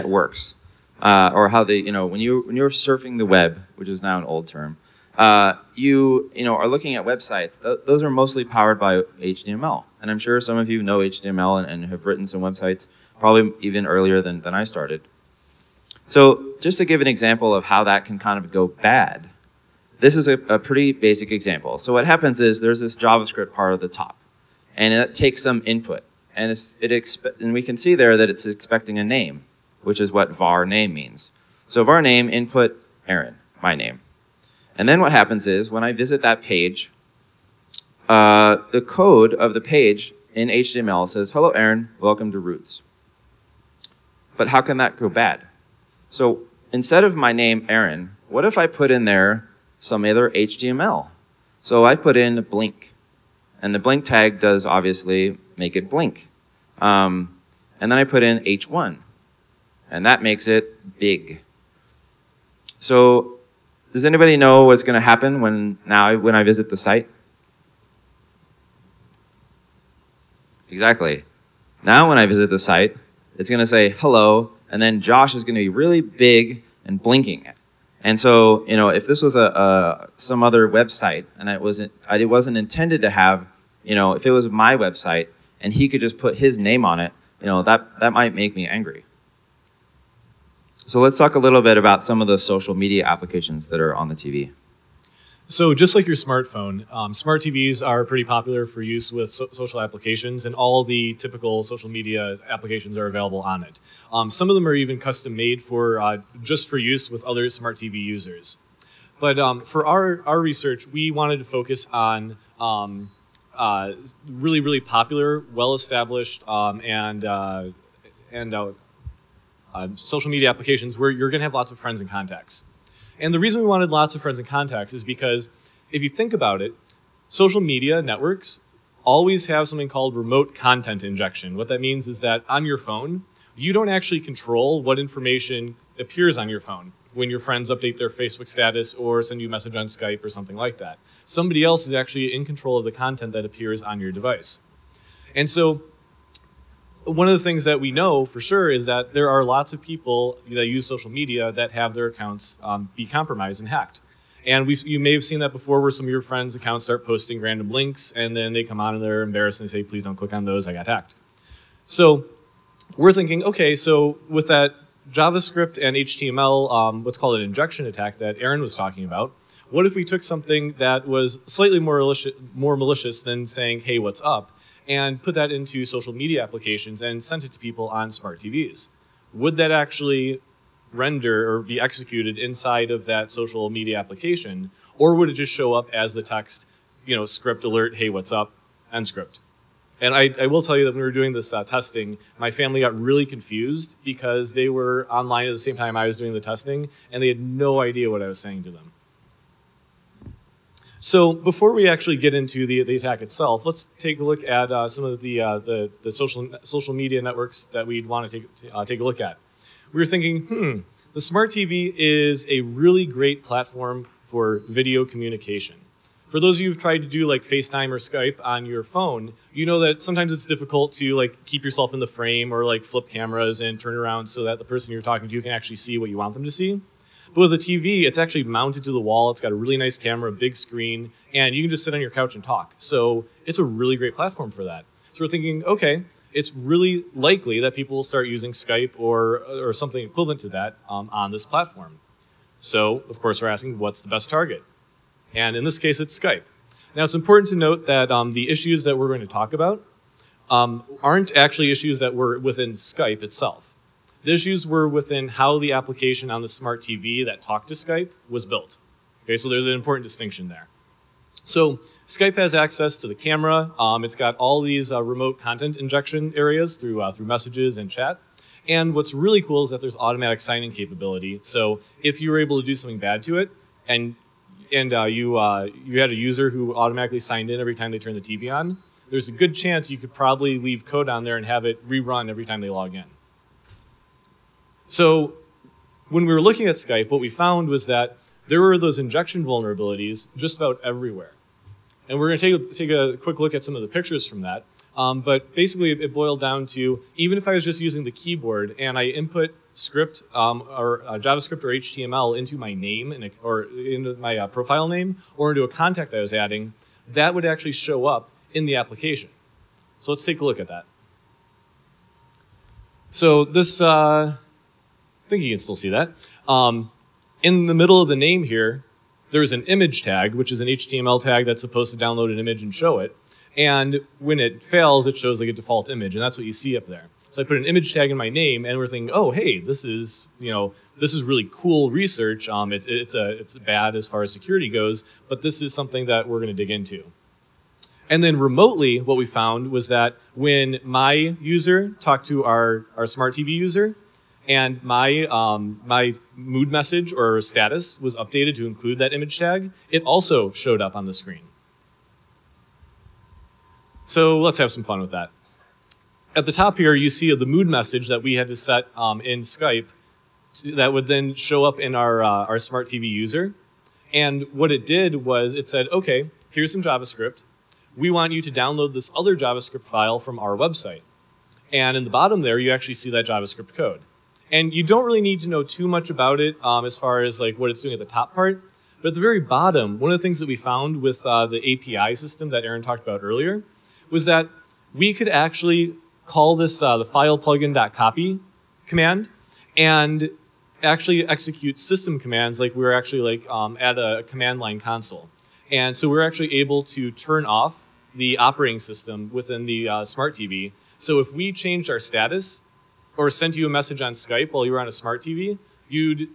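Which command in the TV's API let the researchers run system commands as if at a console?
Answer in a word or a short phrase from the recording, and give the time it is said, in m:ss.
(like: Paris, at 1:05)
file plugin.copy, at 6:27.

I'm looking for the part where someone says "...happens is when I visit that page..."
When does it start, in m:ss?
0:35.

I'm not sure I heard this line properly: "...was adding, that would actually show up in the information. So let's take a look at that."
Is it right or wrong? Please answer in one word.
wrong.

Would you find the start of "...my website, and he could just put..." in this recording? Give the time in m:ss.
1:24.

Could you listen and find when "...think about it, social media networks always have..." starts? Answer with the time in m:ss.
2:06.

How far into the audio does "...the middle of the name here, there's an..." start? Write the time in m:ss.
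5:17.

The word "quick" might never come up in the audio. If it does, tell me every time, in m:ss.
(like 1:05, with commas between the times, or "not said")
4:53.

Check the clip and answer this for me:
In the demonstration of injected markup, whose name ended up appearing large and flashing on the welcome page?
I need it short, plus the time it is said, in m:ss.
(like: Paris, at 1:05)
Josh, at 1:15.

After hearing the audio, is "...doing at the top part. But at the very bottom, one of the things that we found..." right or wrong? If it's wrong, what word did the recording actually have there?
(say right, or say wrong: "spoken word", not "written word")
right.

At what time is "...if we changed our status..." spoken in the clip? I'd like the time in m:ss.
6:41.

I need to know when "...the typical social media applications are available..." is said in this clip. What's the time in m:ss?
1:40.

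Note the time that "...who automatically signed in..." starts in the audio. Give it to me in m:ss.
4:36.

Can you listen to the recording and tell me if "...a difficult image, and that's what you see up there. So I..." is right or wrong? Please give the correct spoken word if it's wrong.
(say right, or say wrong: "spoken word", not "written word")
wrong: "default", not "difficult".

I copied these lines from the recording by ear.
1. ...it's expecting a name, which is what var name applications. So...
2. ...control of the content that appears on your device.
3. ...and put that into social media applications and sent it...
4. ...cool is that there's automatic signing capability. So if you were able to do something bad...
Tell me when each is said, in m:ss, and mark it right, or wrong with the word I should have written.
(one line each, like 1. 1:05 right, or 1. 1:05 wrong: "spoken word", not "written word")
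1. 0:28 wrong: "means", not "applications"
2. 2:22 right
3. 2:54 right
4. 4:29 right.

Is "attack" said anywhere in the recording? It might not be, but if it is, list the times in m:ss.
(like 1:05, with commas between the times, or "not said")
2:47, 3:22.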